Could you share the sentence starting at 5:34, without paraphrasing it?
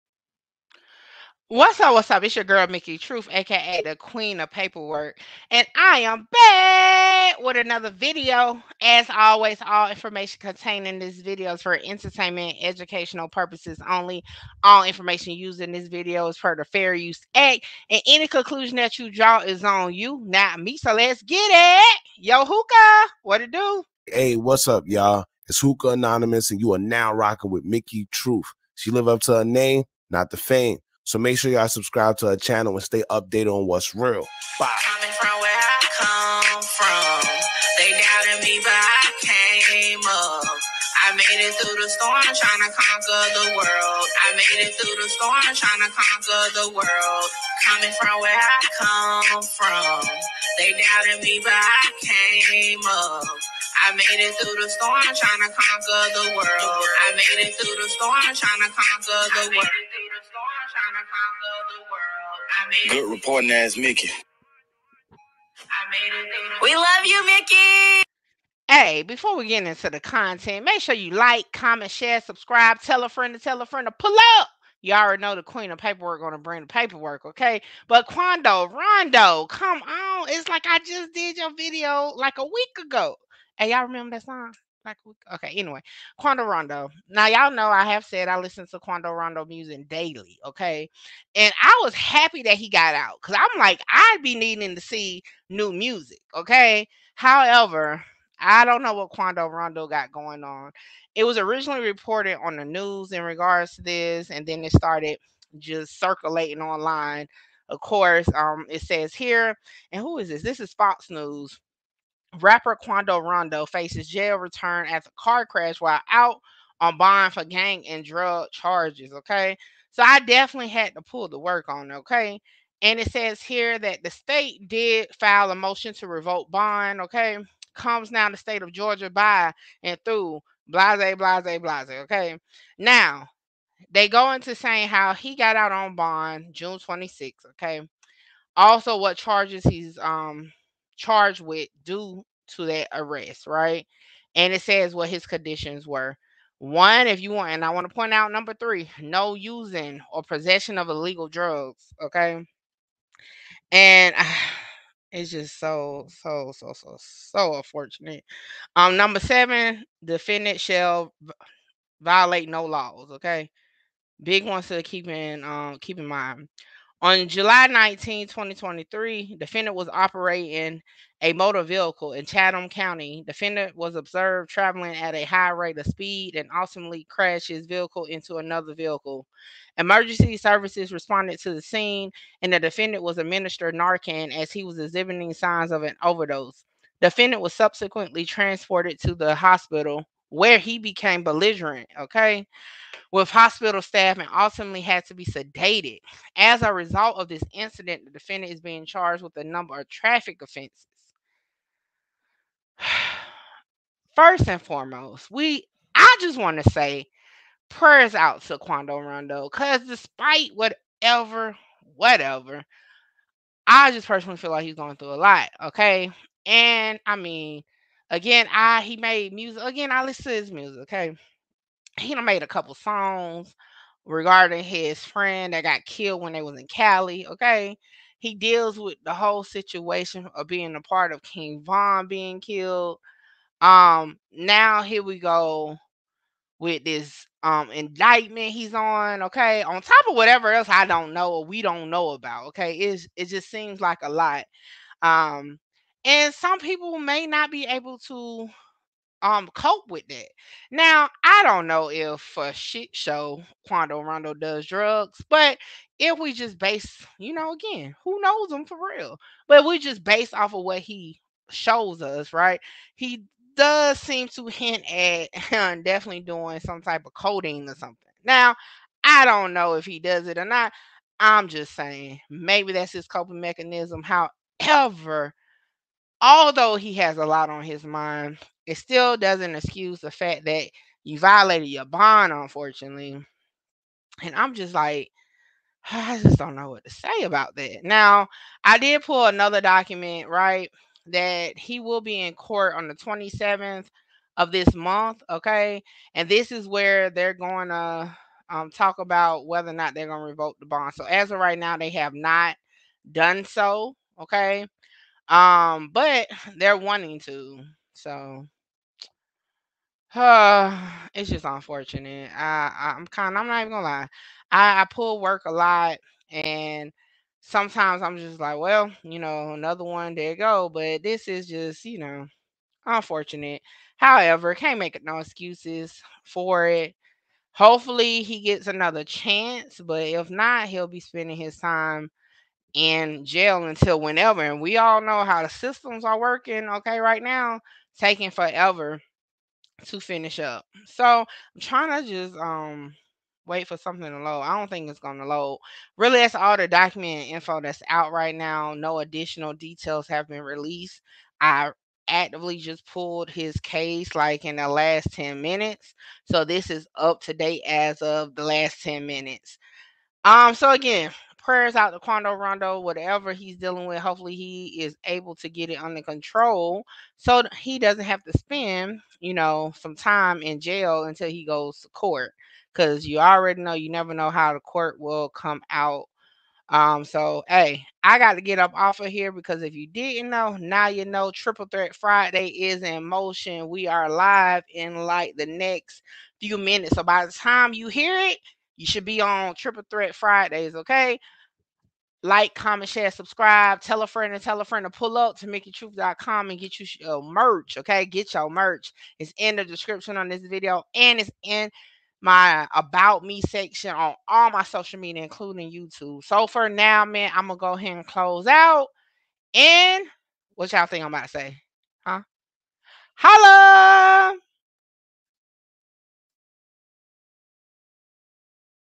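And we all know how the systems are working, okay, right now, taking forever to finish up.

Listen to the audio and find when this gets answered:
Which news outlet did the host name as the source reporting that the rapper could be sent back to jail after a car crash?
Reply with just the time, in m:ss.
1:50.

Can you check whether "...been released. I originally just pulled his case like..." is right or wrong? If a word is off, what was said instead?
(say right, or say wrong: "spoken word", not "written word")
wrong: "actively", not "originally".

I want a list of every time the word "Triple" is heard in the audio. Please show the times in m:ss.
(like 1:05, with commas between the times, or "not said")
6:21, 6:29.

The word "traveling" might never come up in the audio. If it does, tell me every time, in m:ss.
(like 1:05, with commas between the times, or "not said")
2:54.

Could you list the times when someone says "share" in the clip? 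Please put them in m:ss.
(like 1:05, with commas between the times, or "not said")
1:11, 6:32.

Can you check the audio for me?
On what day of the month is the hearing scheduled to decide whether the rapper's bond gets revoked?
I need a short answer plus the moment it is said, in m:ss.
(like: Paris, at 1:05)
27th, at 4:52.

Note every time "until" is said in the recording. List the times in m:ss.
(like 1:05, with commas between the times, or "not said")
5:33, 6:11.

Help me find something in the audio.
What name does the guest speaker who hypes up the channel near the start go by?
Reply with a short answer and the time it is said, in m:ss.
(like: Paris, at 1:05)
Hookah Anonymous, at 0:25.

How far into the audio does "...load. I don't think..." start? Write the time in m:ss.
5:44.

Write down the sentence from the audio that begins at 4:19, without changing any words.
But we just base off of what he shows us, right?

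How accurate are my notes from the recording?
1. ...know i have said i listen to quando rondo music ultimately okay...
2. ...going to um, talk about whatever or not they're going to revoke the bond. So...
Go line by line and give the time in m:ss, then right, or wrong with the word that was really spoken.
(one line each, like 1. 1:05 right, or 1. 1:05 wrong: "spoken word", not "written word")
1. 1:27 wrong: "daily", not "ultimately"
2. 4:57 wrong: "whether", not "whatever".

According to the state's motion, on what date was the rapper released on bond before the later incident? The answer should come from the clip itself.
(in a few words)
June 26.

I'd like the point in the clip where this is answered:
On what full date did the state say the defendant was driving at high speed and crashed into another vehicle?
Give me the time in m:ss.
2:47.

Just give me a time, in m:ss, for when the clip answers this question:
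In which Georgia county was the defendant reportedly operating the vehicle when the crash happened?
2:52.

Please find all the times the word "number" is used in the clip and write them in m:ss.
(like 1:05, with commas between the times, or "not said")
2:28, 2:38, 3:19.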